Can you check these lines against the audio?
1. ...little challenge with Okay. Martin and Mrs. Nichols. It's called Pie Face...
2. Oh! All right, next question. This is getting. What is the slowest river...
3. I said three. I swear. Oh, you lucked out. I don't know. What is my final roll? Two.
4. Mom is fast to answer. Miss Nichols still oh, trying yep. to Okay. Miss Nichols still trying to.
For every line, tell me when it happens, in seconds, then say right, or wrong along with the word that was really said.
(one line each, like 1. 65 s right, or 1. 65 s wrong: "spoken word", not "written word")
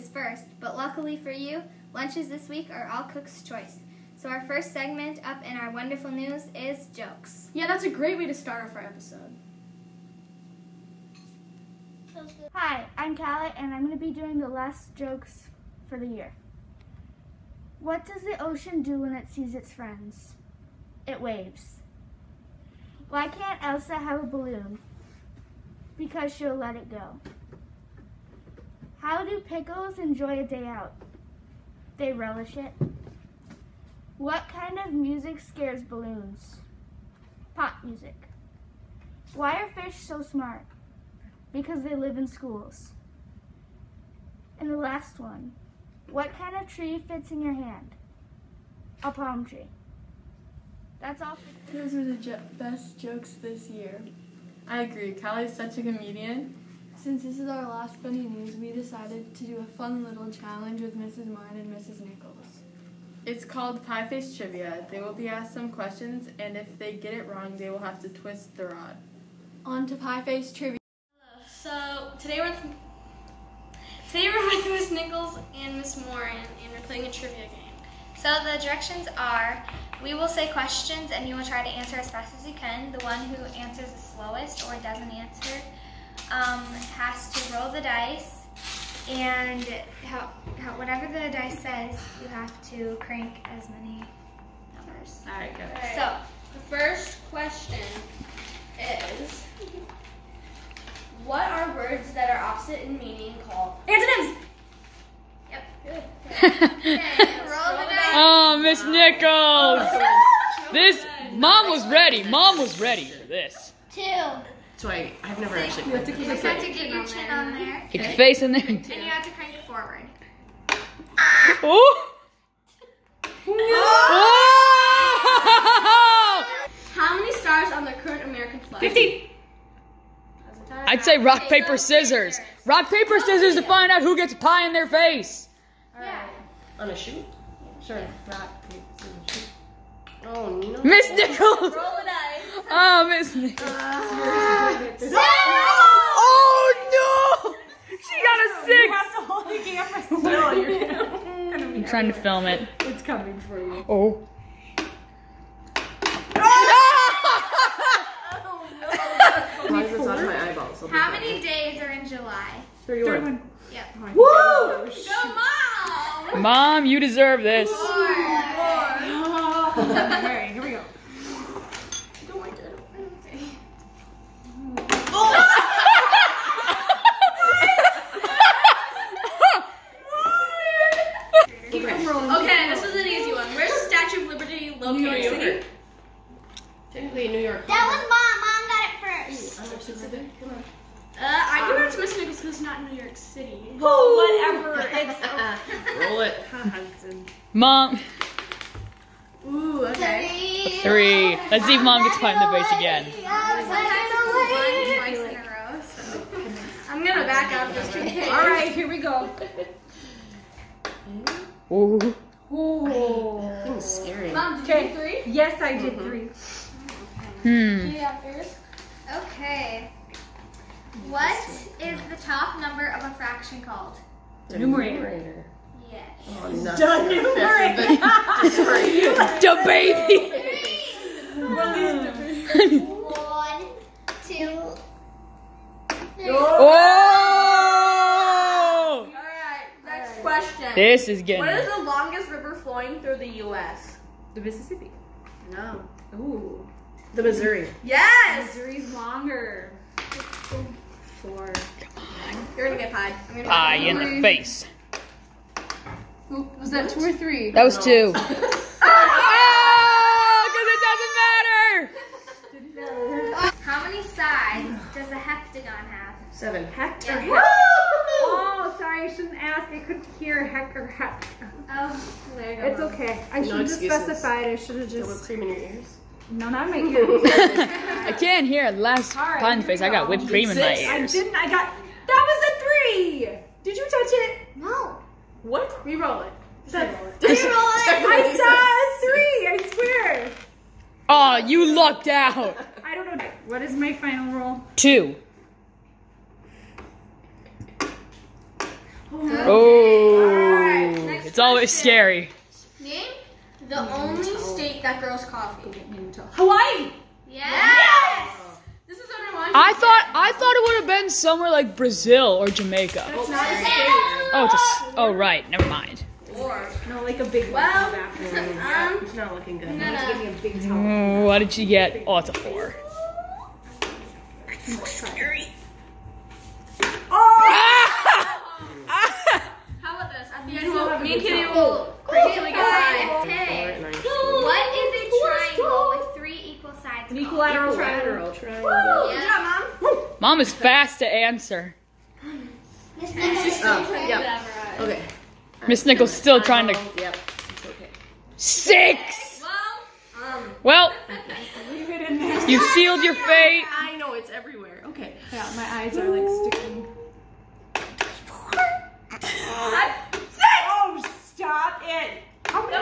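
1. 60 s wrong: "Mrs", not "Okay"
2. 236 s wrong: "longest", not "slowest"
3. 288 s right
4. 340 s right.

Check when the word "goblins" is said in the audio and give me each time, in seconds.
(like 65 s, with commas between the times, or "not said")
not said.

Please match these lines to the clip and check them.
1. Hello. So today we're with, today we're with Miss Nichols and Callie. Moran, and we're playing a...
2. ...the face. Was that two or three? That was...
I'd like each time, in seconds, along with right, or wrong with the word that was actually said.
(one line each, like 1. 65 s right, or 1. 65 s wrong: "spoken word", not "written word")
1. 71 s wrong: "Mrs", not "Callie"
2. 253 s right.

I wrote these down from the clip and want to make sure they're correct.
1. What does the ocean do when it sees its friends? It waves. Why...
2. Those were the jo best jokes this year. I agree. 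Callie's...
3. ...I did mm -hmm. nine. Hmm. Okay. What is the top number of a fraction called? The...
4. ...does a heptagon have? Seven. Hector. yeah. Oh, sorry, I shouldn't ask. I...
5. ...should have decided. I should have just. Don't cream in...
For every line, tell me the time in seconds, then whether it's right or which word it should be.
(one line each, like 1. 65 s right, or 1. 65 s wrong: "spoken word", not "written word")
1. 17 s right
2. 51 s right
3. 215 s wrong: "three", not "nine"
4. 264 s right
5. 273 s wrong: "specified", not "decided".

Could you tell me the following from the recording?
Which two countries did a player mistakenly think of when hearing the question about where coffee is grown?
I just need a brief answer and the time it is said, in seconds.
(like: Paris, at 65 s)
Brazil or Jamaica, at 311 s.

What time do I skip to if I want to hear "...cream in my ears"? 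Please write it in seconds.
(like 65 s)
280 s.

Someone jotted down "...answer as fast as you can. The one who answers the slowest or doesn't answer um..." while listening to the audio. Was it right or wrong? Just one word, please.
right.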